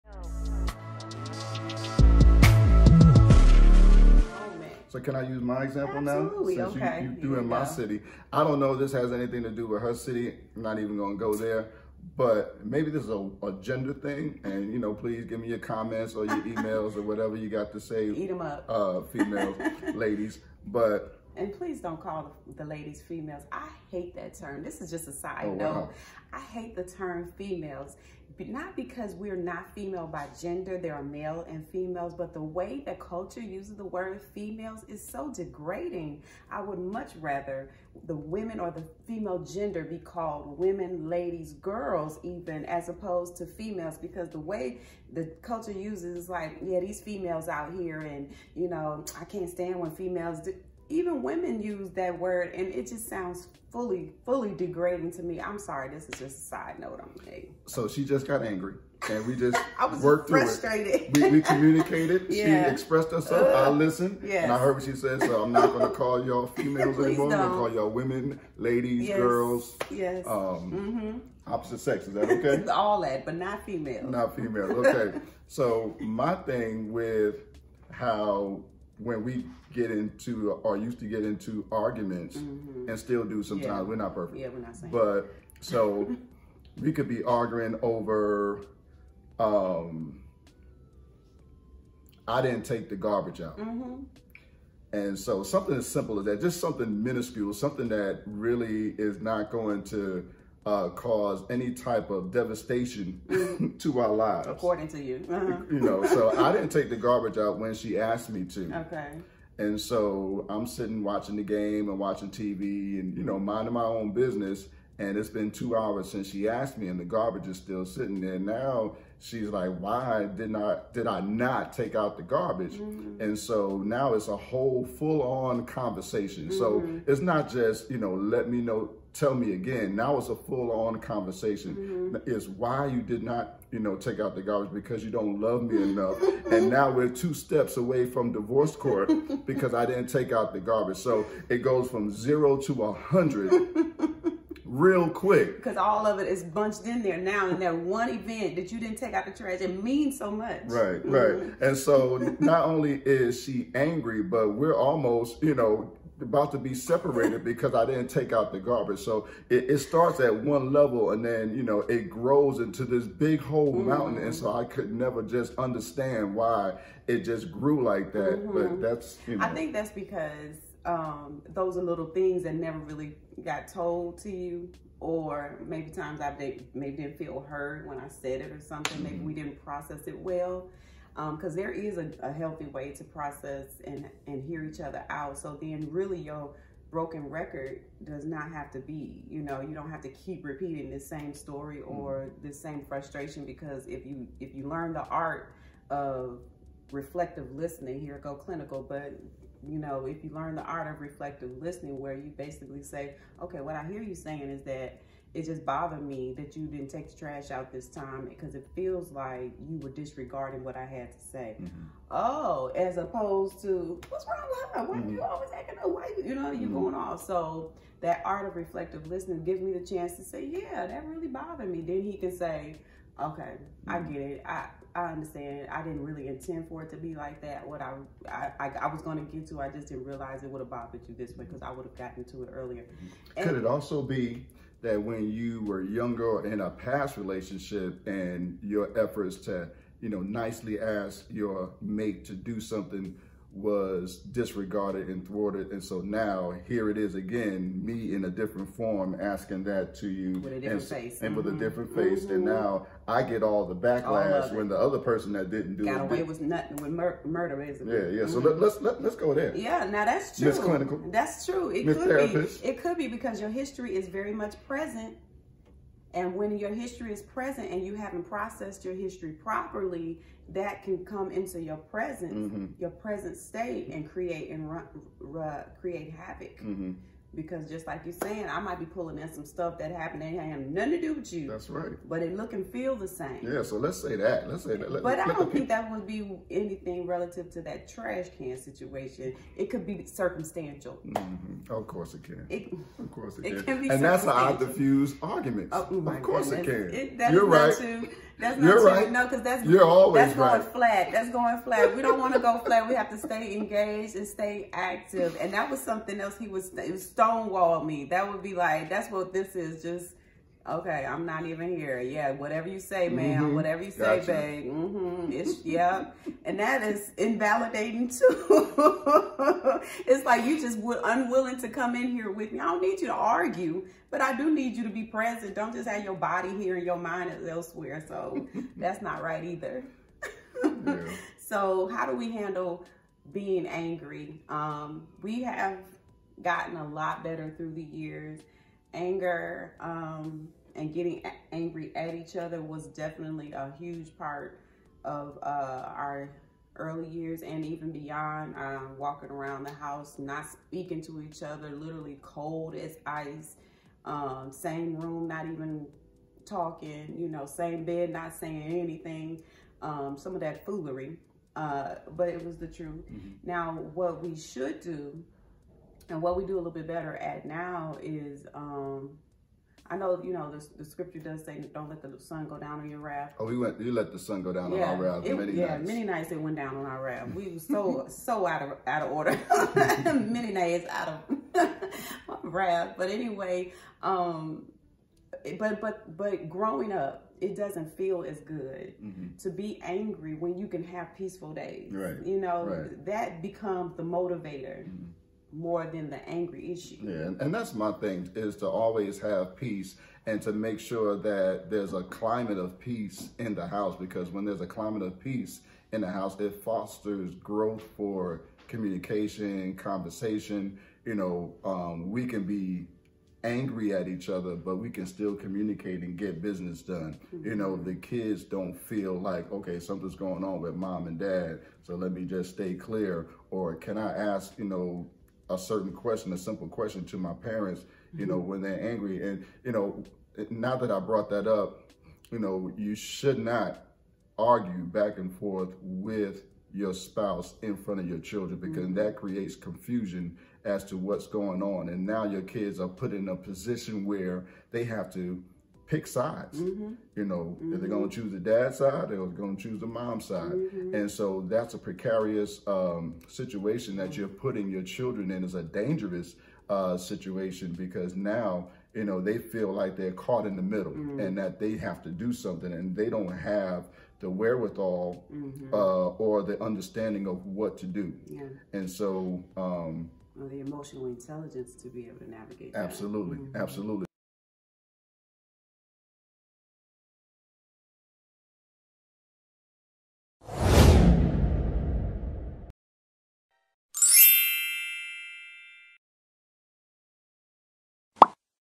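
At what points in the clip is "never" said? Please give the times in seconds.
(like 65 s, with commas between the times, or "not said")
164 s, 172 s.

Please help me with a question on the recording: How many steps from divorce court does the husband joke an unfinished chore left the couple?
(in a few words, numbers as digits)
2.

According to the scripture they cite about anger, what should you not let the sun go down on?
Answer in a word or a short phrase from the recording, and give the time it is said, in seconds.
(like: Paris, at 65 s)
Your wrath, at 372 s.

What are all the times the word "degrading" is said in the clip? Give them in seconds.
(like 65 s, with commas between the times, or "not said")
35 s, 54 s.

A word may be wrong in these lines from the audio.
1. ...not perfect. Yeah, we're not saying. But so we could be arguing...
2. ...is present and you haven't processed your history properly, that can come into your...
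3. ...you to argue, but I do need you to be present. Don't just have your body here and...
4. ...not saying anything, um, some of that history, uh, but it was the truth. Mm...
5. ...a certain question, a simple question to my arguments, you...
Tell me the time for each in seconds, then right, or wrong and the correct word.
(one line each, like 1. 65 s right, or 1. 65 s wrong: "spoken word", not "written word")
1. 83 s right
2. 267 s right
3. 323 s right
4. 358 s wrong: "foolery", not "history"
5. 425 s wrong: "parents", not "arguments".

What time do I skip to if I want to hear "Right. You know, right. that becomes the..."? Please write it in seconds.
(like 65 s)
391 s.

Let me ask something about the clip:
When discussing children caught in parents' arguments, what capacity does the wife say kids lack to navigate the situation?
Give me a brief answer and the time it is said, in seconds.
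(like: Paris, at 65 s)
Emotional intelligence, at 470 s.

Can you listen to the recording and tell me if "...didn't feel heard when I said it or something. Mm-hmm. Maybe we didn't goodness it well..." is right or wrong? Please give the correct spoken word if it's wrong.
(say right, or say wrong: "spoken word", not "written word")
wrong: "process", not "goodness".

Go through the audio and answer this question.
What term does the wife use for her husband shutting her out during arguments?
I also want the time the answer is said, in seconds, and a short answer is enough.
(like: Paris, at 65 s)
Stonewalled, at 306 s.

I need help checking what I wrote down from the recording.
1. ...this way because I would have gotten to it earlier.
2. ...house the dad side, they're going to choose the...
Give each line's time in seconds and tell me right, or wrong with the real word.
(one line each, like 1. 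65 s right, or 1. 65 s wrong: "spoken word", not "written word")
1. 231 s right
2. 448 s wrong: "choose", not "house".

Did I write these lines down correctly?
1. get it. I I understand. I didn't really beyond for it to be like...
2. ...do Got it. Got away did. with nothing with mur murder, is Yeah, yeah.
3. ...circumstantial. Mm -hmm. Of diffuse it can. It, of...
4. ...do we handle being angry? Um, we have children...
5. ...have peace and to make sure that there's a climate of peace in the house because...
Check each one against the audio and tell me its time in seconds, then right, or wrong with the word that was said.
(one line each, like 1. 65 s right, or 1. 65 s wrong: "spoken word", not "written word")
1. 224 s wrong: "intend", not "beyond"
2. 255 s right
3. 290 s wrong: "course", not "diffuse"
4. 332 s wrong: "gotten", not "children"
5. 399 s right.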